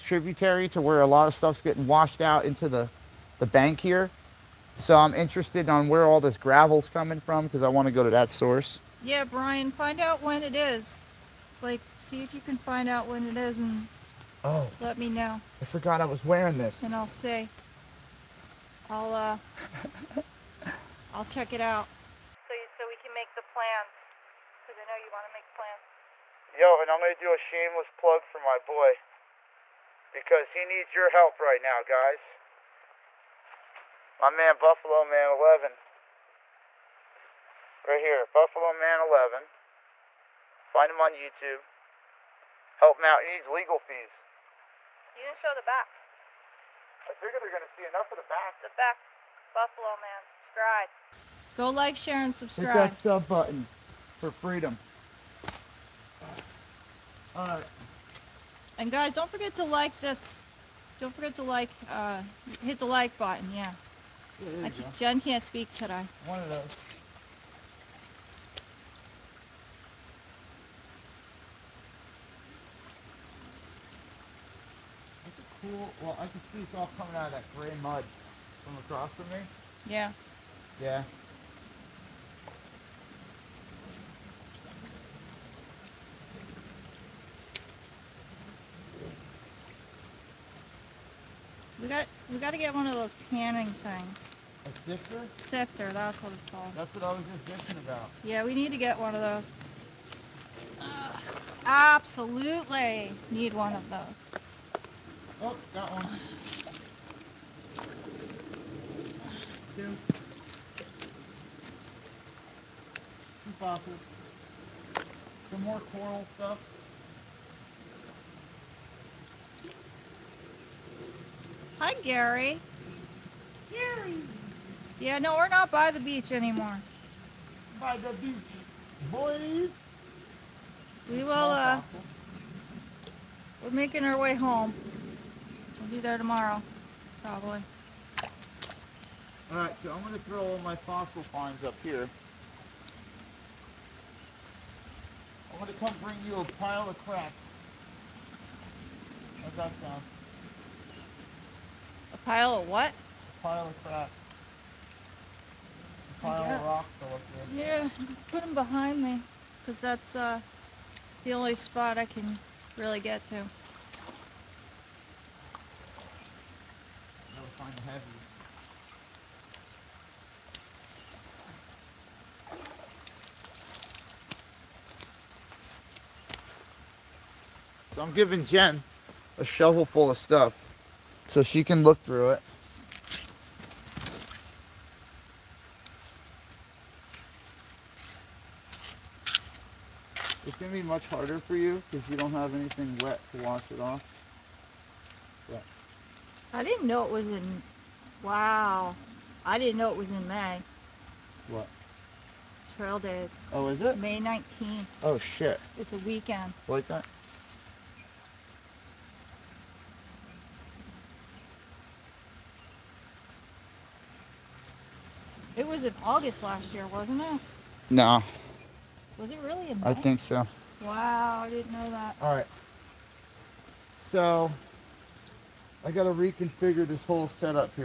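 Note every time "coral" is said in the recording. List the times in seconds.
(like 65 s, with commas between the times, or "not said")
115 s.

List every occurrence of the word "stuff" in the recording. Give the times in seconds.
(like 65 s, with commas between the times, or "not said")
1 s, 116 s, 180 s.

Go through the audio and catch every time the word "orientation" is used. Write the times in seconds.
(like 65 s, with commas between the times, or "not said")
not said.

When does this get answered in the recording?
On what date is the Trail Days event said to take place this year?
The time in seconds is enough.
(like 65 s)
203 s.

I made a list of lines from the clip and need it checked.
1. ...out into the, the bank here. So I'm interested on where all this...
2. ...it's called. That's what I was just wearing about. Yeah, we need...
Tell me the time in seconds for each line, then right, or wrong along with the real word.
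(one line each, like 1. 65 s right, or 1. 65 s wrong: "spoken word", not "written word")
1. 2 s right
2. 96 s wrong: "thinking", not "wearing".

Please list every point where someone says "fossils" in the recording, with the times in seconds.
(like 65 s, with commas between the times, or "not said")
113 s, 140 s.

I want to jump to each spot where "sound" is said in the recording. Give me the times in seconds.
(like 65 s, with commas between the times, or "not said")
149 s.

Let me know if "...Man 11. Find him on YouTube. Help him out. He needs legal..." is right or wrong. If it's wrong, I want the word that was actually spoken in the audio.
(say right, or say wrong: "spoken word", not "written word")
right.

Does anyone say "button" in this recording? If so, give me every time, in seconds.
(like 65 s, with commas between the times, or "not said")
53 s, 63 s.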